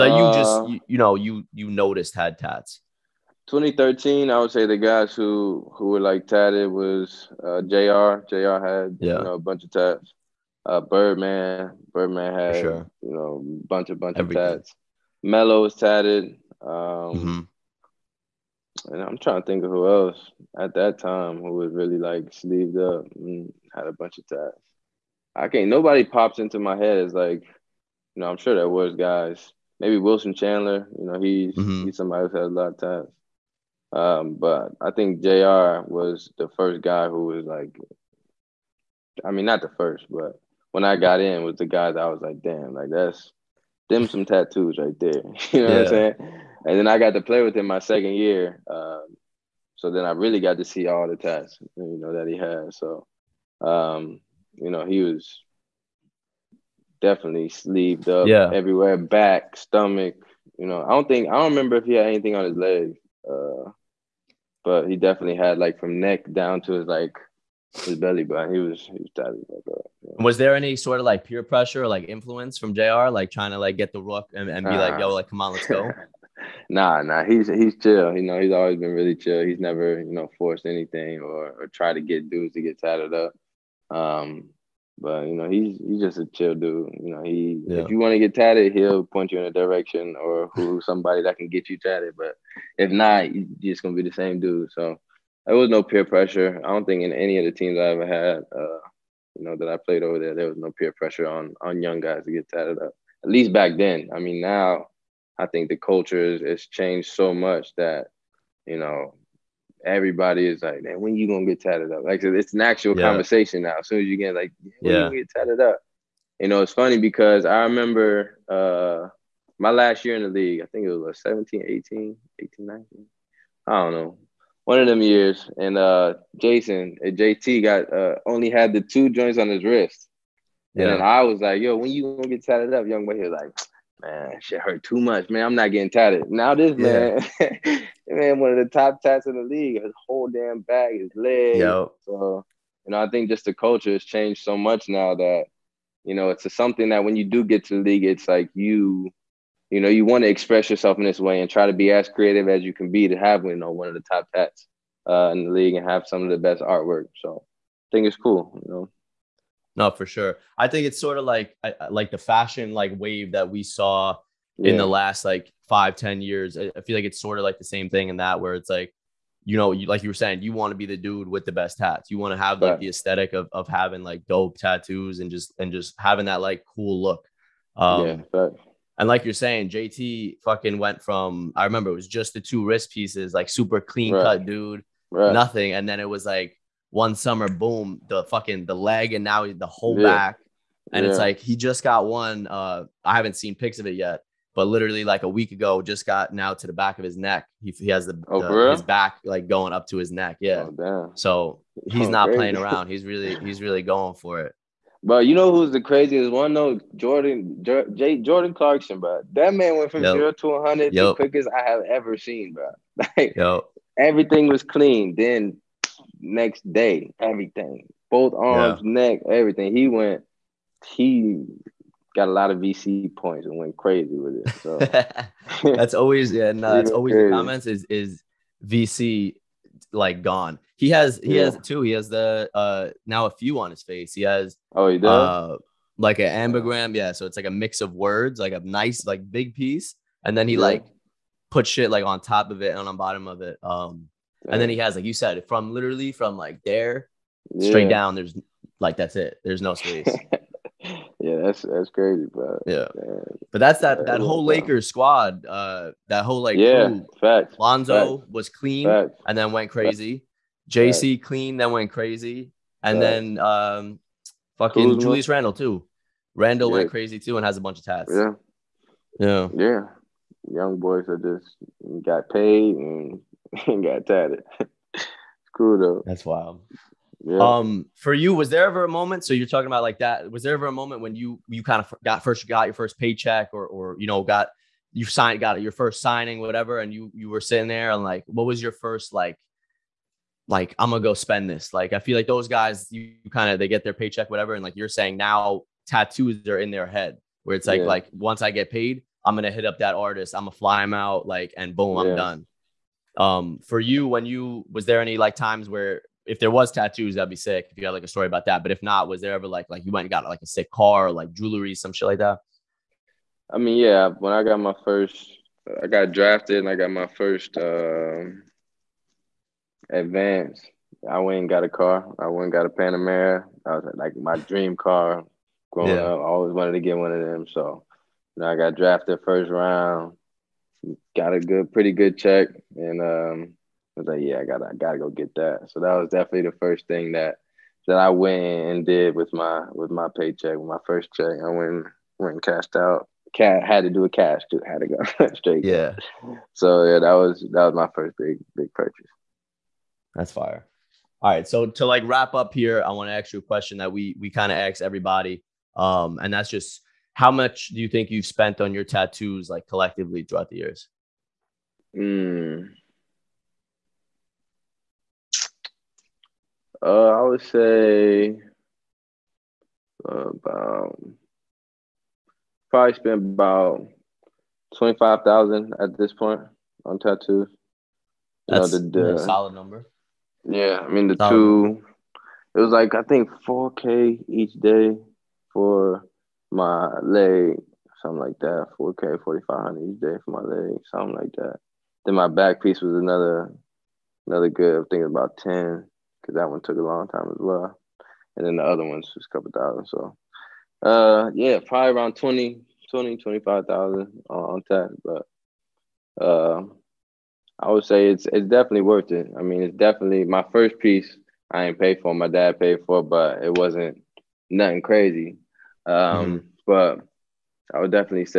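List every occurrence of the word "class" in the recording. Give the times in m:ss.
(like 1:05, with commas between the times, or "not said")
not said.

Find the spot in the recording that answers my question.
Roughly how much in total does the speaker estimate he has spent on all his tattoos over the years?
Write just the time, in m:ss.
6:14.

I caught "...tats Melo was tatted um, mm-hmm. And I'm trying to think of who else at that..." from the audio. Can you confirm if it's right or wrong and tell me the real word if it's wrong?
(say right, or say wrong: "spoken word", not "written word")
right.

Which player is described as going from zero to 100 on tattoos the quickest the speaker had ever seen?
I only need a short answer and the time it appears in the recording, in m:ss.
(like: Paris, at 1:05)
Jordan Clarkson, at 3:28.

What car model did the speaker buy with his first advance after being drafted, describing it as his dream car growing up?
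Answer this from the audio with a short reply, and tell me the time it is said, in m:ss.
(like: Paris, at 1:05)
Panamera, at 5:22.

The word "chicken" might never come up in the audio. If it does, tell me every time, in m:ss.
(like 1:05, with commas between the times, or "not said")
not said.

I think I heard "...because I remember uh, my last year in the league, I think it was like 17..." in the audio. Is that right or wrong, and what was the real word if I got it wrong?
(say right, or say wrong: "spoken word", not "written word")
right.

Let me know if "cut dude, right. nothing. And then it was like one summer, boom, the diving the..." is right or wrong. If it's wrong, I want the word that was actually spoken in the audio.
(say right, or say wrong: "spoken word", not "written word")
wrong: "fucking", not "diving".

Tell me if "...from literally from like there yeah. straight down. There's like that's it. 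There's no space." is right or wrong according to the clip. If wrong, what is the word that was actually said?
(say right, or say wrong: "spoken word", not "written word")
right.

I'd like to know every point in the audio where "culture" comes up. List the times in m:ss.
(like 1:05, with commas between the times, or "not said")
1:45, 2:23.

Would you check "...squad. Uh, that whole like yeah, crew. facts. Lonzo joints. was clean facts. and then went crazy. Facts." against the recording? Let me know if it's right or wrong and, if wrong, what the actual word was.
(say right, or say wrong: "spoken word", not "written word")
wrong: "facts", not "joints".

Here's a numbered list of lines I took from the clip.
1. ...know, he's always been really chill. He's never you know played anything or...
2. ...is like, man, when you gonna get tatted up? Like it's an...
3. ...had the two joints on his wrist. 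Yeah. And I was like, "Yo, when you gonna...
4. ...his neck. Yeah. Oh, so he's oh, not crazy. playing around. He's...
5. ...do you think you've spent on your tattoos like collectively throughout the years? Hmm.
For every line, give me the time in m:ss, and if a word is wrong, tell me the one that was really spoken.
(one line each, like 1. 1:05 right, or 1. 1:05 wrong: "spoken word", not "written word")
1. 1:18 wrong: "forced", not "played"
2. 1:50 right
3. 2:08 right
4. 3:19 right
5. 5:57 right.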